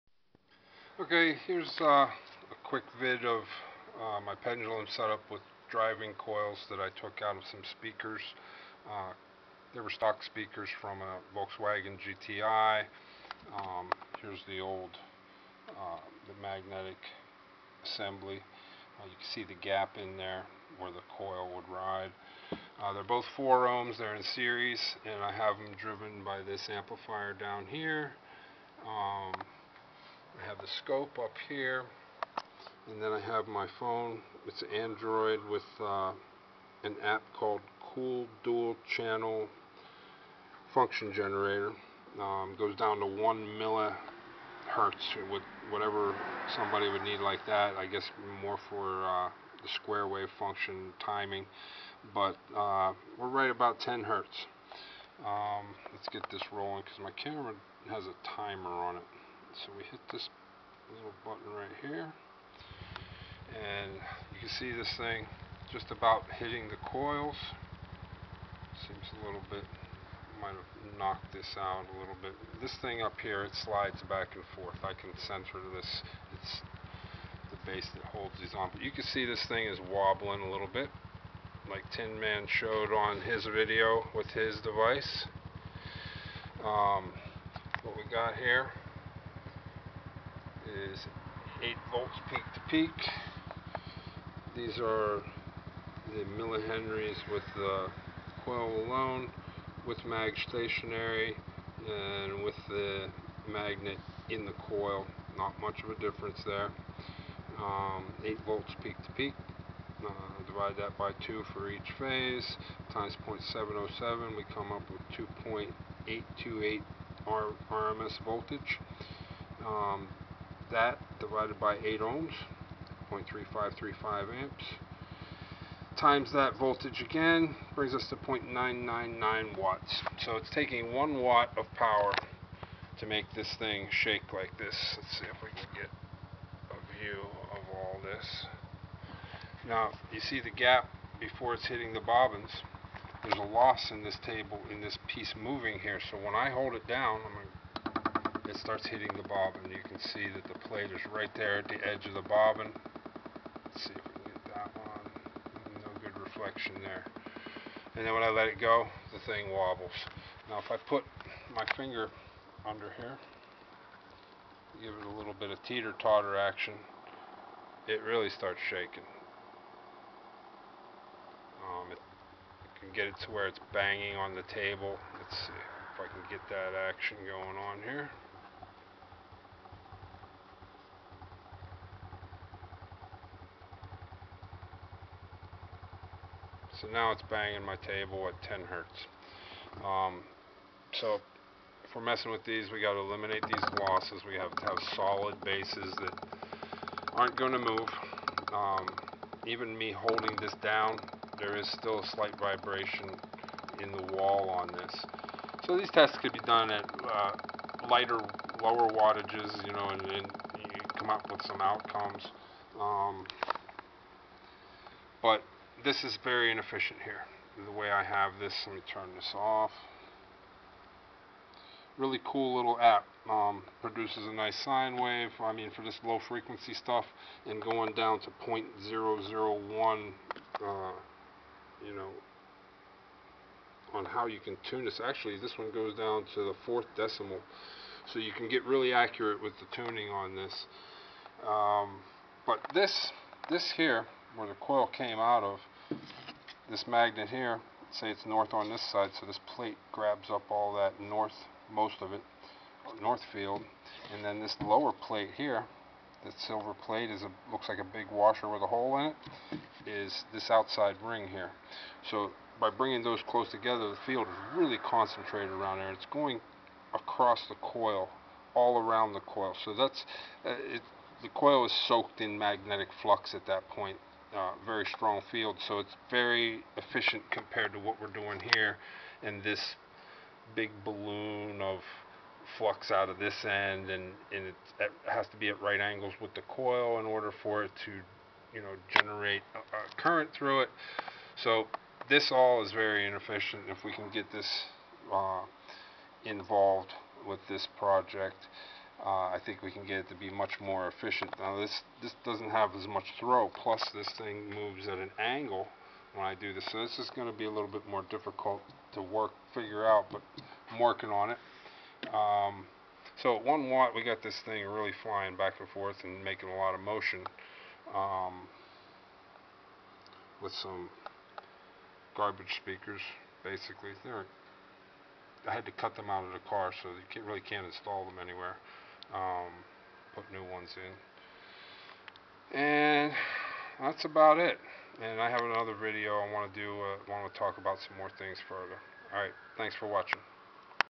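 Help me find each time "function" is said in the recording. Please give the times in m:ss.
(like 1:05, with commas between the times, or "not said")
0:40, 0:50.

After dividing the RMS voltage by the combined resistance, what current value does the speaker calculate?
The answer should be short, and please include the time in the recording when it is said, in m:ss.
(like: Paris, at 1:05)
0.3535 amps, at 2:03.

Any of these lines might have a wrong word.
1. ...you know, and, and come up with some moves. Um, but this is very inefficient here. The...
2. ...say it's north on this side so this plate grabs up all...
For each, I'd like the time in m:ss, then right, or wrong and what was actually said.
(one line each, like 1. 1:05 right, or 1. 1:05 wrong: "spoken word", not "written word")
1. 3:29 wrong: "outcomes", not "moves"
2. 4:07 right.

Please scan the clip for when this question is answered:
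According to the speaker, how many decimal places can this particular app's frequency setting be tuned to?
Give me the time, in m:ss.
3:56.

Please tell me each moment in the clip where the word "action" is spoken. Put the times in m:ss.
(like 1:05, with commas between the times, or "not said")
2:46, 2:56.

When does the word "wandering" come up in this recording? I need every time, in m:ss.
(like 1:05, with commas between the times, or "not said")
not said.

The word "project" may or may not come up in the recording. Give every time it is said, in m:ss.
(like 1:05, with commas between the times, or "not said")
4:57.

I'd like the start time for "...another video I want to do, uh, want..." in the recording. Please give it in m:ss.
5:35.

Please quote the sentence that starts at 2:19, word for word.
Now, you see the gap before it's hitting the bobbins.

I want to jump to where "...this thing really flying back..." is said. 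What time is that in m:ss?
5:14.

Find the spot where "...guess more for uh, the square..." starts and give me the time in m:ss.
0:47.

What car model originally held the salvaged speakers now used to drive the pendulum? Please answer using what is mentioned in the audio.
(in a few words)
Volkswagen GTI.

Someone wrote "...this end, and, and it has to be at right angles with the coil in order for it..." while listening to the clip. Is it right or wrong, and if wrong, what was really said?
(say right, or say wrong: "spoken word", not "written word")
right.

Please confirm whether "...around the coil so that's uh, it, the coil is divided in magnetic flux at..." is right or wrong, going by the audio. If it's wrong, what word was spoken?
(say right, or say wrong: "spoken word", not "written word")
wrong: "soaked", not "divided".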